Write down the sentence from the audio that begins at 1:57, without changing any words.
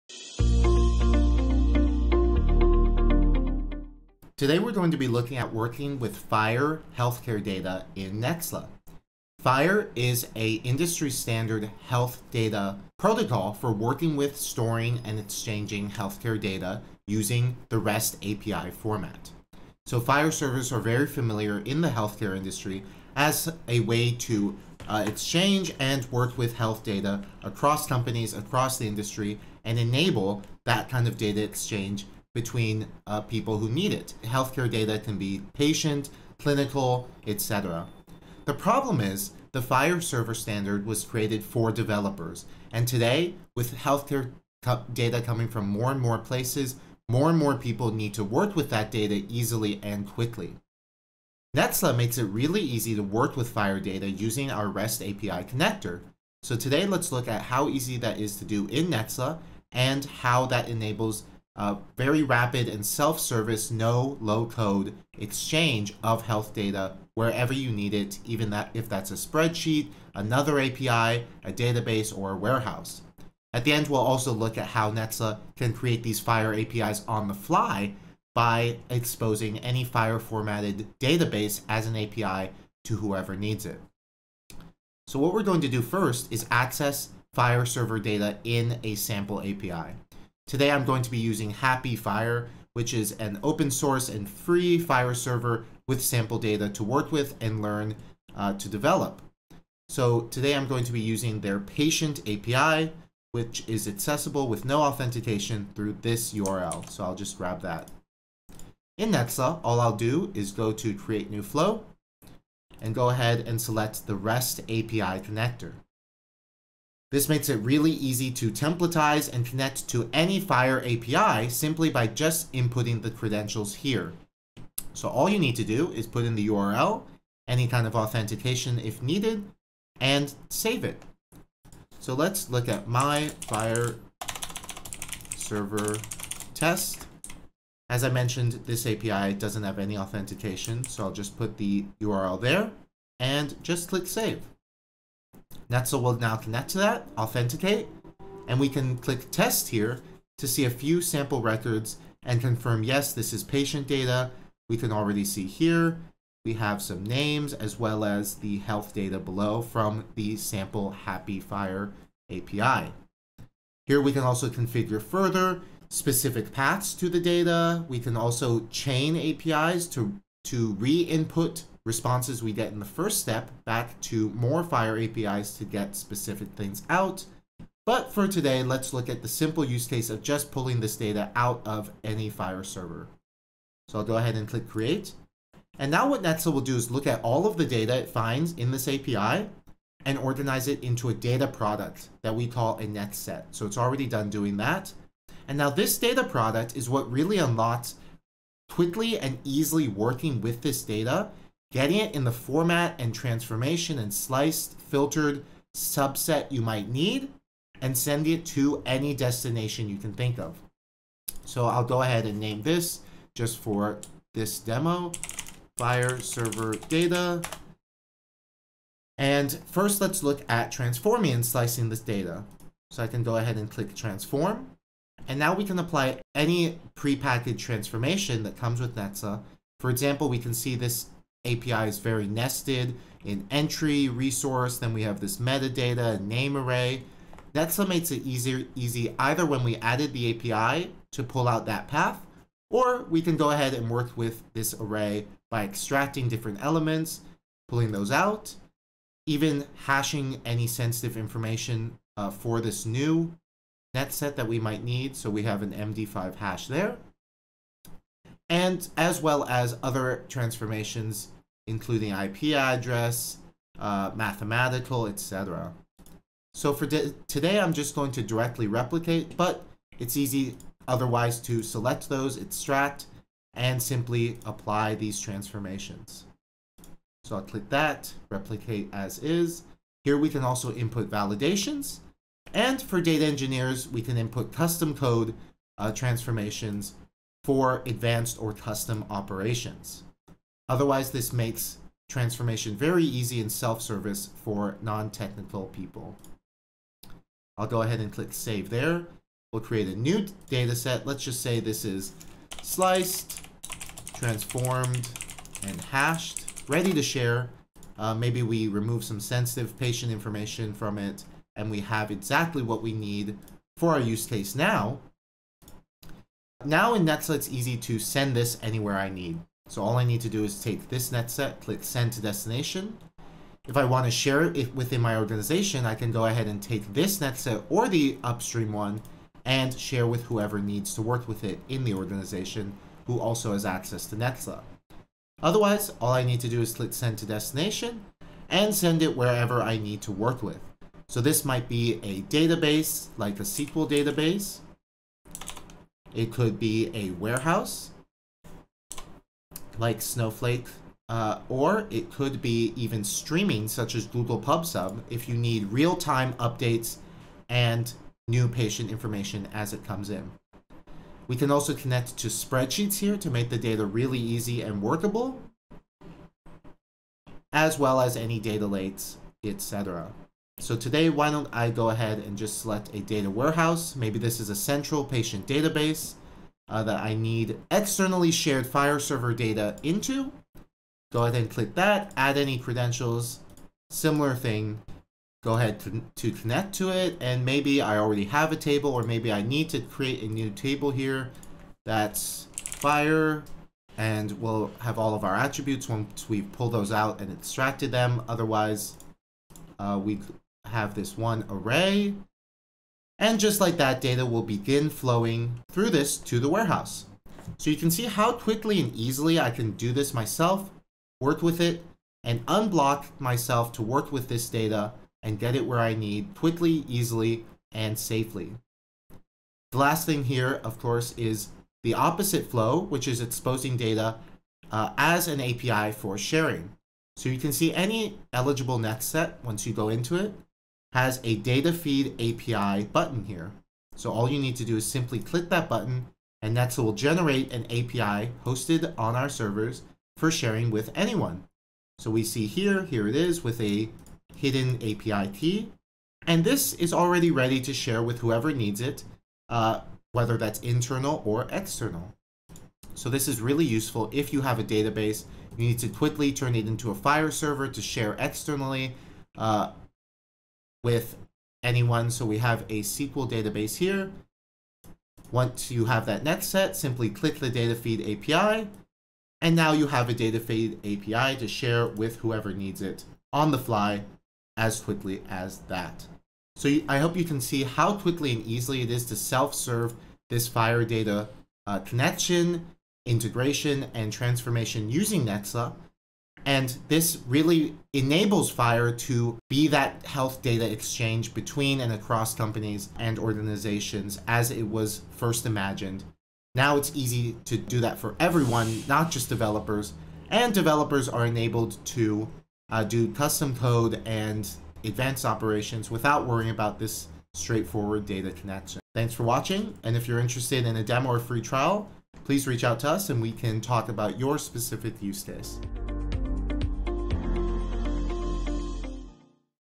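This makes it really easy to templatize and connect to any FHIR API simply by just inputting the credentials here.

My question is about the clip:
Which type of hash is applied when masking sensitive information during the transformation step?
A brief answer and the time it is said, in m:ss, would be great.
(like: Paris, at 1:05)
MD5, at 4:15.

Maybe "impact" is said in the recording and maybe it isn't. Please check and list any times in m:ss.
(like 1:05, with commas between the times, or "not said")
not said.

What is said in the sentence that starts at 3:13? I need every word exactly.
So it's already done doing that.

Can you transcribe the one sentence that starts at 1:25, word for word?
So what we're going to do first is access FHIR server data in a sample API.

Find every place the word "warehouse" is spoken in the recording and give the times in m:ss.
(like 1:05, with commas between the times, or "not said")
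1:12, 5:47, 6:13, 6:46.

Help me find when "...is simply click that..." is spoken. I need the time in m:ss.
7:14.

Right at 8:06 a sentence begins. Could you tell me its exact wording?
And this really enables FHIR to be that health data exchange between and across companies and organizations as it was first imagined.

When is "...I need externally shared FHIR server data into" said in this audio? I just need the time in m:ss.
6:17.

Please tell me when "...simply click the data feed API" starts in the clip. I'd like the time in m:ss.
7:46.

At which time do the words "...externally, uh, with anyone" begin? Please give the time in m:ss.
7:38.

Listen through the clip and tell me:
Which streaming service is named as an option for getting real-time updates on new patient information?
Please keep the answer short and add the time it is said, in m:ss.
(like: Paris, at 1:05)
Google PubSub, at 5:54.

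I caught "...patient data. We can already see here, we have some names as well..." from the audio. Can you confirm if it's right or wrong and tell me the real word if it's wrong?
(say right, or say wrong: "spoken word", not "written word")
right.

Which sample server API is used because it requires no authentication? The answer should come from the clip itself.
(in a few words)
patient API.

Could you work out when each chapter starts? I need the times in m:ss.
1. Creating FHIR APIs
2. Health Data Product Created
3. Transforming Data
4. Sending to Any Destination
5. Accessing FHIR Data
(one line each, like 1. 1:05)
1. 6:59
2. 3:04
3. 3:40
4. 5:15
5. 1:24.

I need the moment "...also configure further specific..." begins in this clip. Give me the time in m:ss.
2:44.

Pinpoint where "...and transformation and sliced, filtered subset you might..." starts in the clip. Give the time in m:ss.
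3:22.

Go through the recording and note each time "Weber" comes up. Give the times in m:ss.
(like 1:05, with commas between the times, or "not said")
not said.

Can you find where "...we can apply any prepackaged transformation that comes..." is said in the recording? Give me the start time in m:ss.
3:45.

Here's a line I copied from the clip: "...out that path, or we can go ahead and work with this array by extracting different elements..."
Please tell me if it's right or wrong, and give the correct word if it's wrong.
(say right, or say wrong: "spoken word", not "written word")
right.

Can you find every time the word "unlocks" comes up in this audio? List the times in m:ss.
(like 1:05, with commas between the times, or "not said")
3:17.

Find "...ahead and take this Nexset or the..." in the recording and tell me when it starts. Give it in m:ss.
5:26.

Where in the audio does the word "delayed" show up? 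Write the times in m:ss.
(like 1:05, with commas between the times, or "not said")
not said.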